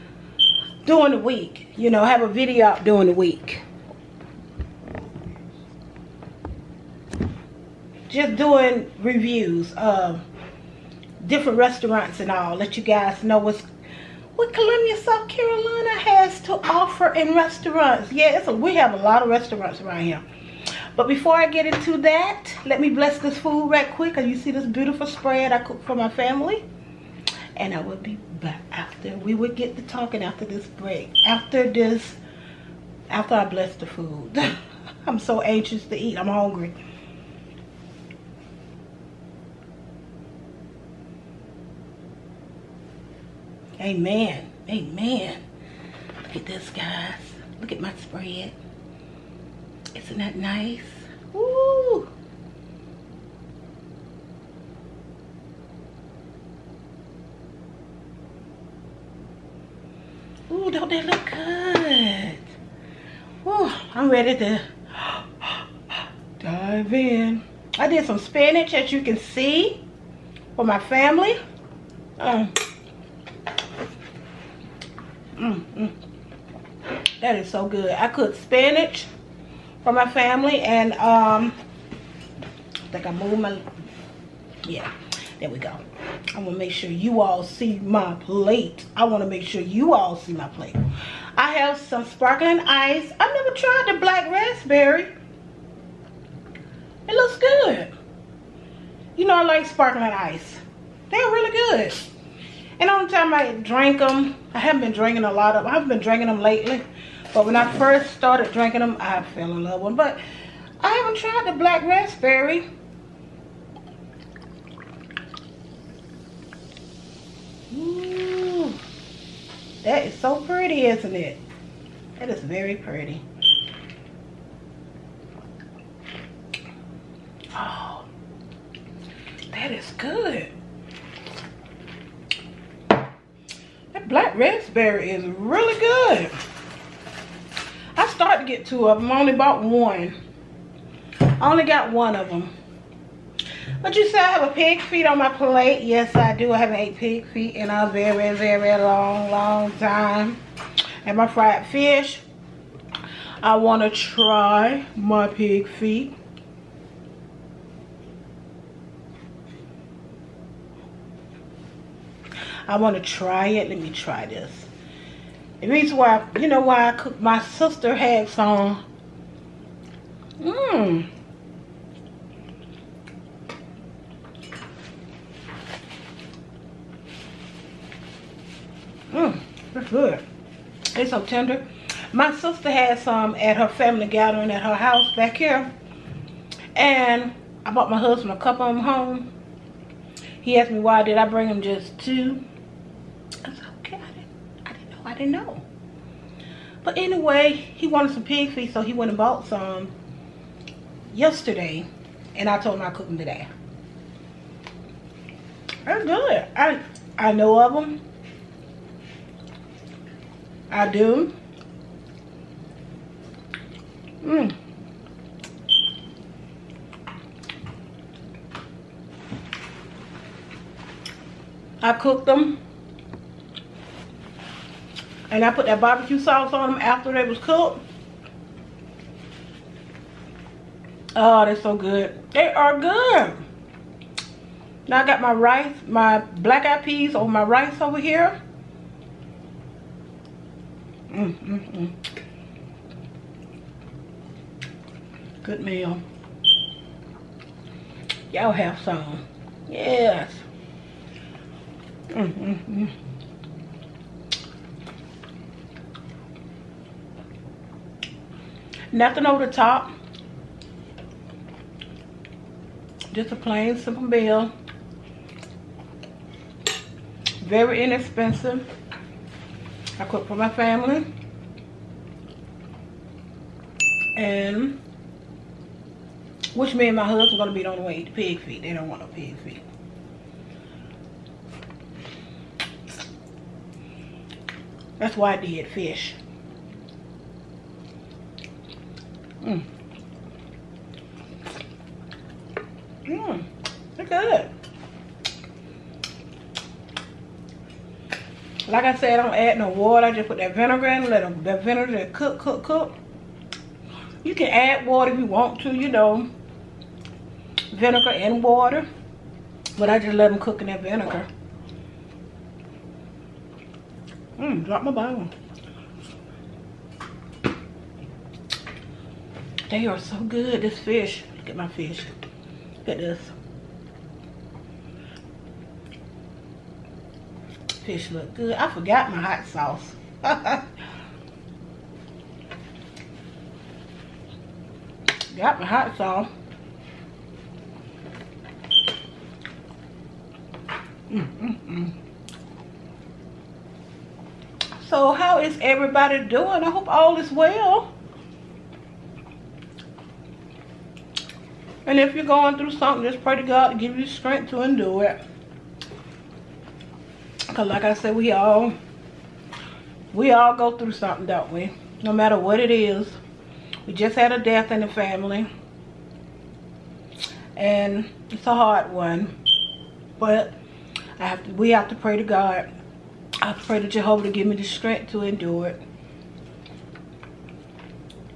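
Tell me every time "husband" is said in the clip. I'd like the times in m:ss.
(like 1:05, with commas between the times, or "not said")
3:07, 4:37.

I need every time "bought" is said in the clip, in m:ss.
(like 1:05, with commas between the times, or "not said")
2:19, 3:07, 3:19.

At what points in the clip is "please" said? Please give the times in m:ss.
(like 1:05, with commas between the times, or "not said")
not said.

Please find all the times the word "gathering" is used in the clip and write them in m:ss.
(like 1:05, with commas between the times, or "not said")
3:04.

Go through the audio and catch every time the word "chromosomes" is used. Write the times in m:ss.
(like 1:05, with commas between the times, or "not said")
not said.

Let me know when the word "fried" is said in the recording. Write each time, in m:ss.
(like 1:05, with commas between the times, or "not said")
2:31.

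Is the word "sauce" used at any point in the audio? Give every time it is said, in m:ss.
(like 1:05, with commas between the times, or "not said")
3:46, 5:29, 5:35.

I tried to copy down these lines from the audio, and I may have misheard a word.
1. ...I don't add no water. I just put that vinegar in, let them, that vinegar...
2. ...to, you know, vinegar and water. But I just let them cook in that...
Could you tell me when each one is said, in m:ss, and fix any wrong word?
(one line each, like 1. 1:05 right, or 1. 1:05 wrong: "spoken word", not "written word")
1. 4:59 right
2. 5:05 right.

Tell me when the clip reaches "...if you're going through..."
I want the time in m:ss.
5:51.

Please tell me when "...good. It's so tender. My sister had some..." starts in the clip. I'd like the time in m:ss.
2:59.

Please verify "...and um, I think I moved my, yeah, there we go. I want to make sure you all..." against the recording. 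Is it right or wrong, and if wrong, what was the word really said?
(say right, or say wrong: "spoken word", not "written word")
right.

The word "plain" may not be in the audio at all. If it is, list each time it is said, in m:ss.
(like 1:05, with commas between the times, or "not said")
4:23.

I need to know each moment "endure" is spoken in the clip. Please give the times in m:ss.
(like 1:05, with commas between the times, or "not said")
5:54, 6:15.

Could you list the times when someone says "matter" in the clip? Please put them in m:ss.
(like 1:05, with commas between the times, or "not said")
6:02.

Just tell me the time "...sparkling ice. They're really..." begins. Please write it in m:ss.
1:39.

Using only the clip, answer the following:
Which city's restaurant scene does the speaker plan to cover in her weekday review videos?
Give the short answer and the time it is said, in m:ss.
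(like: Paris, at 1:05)
Columbia, South Carolina, at 0:14.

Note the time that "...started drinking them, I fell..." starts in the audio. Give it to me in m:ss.
1:48.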